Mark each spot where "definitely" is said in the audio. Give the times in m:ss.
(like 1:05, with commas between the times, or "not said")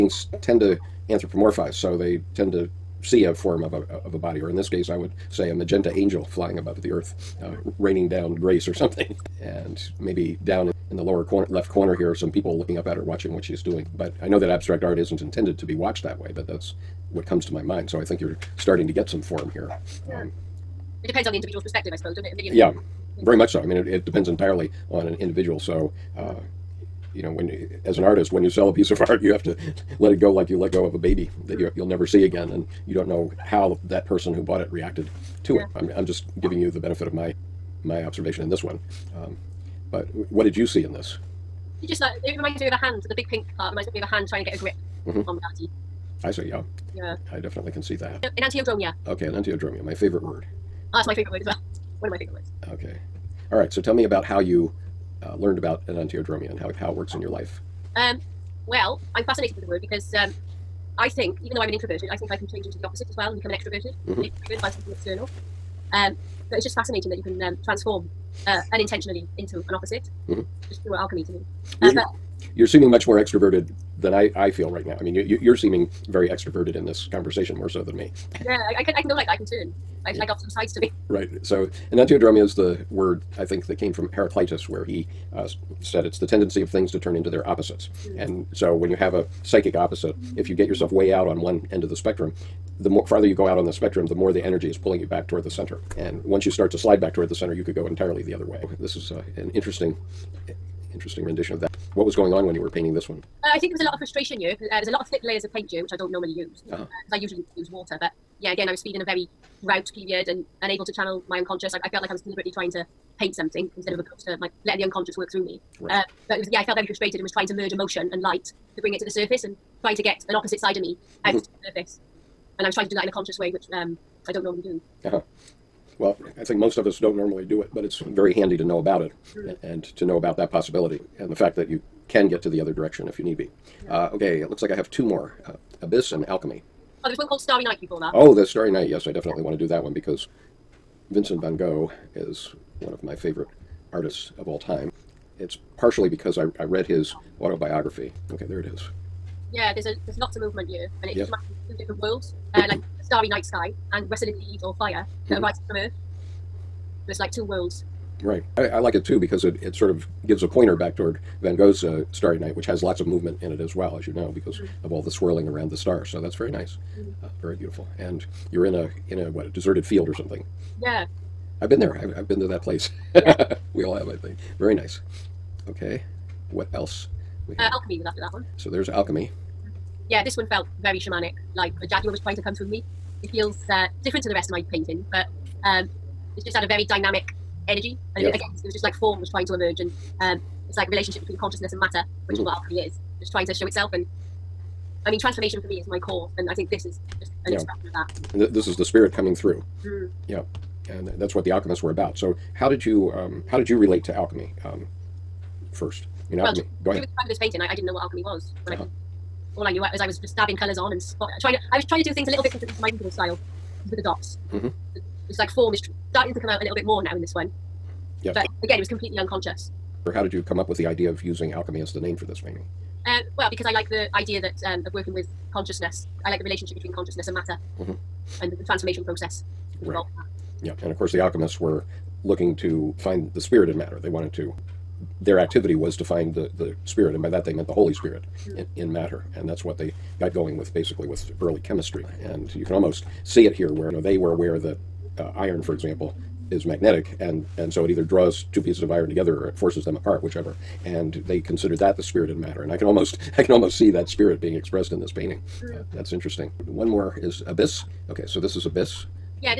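0:47, 2:19.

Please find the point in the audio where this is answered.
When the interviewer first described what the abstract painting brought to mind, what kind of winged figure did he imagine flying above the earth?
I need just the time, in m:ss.
0:05.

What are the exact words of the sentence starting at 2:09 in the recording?
and to know about that possibility and the fact that you can get to the other direction if you need be.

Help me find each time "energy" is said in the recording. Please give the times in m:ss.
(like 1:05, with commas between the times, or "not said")
1:34, 3:07.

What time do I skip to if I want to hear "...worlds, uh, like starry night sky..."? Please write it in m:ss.
2:32.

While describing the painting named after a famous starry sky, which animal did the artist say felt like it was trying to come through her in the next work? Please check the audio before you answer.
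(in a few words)
jaguar.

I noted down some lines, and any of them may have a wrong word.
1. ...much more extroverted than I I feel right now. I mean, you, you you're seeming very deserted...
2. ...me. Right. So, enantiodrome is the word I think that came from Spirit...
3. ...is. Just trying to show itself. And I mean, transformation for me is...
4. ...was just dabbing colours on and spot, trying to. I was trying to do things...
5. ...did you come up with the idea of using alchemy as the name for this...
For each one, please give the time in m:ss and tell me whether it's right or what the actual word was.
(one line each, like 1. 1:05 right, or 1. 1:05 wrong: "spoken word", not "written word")
1. 1:12 wrong: "extroverted", not "deserted"
2. 1:20 wrong: "Heraclitus", not "Spirit"
3. 3:12 right
4. 3:30 right
5. 3:40 right.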